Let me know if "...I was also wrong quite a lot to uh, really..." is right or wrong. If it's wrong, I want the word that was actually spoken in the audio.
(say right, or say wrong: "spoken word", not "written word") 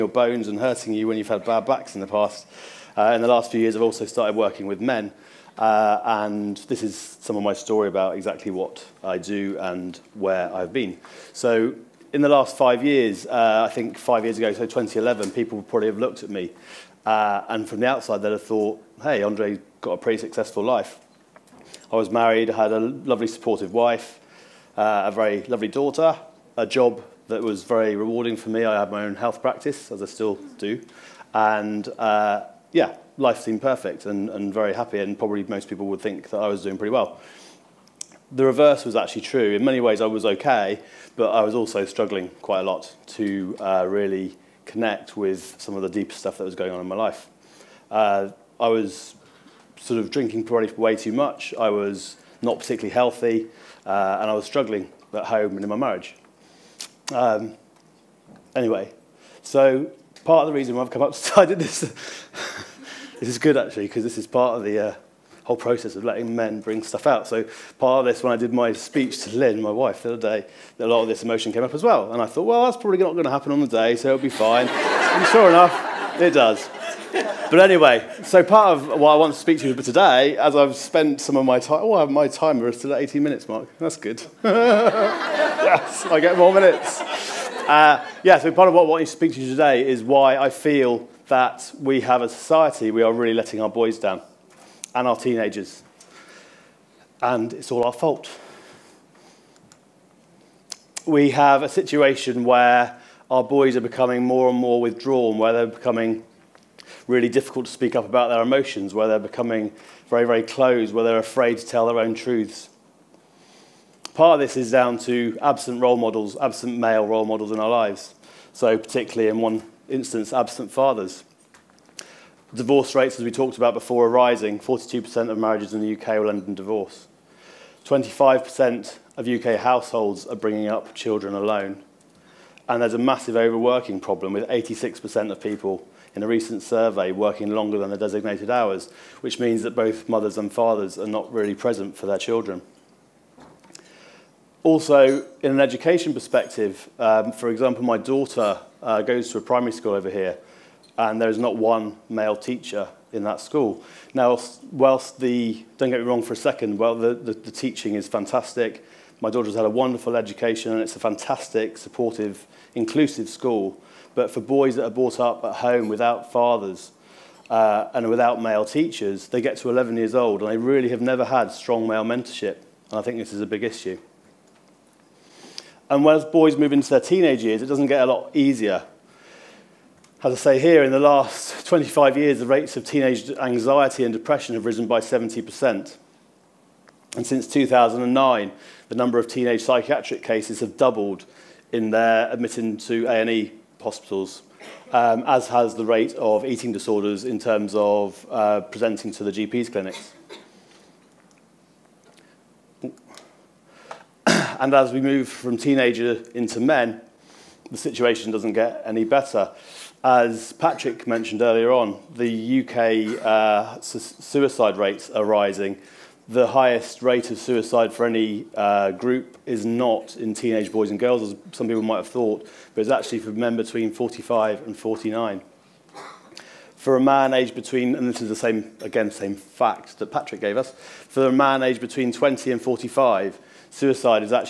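wrong: "struggling", not "wrong".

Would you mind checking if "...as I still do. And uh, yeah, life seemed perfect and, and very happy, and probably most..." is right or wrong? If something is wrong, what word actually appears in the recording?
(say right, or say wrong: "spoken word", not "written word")
right.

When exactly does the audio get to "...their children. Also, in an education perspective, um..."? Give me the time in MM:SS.
02:22.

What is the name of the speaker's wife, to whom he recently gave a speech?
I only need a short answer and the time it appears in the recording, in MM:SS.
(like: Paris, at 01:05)
Lynn, at 01:09.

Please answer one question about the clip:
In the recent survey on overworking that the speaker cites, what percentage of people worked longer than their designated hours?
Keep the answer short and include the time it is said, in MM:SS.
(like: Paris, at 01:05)
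86%, at 02:14.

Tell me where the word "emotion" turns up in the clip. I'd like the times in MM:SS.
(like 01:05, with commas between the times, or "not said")
01:11, 01:48.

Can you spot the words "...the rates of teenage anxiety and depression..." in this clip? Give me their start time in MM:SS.
03:02.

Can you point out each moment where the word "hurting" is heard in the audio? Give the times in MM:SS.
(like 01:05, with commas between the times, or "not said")
00:00.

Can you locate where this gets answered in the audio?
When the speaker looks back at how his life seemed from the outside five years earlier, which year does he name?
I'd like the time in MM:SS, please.
00:14.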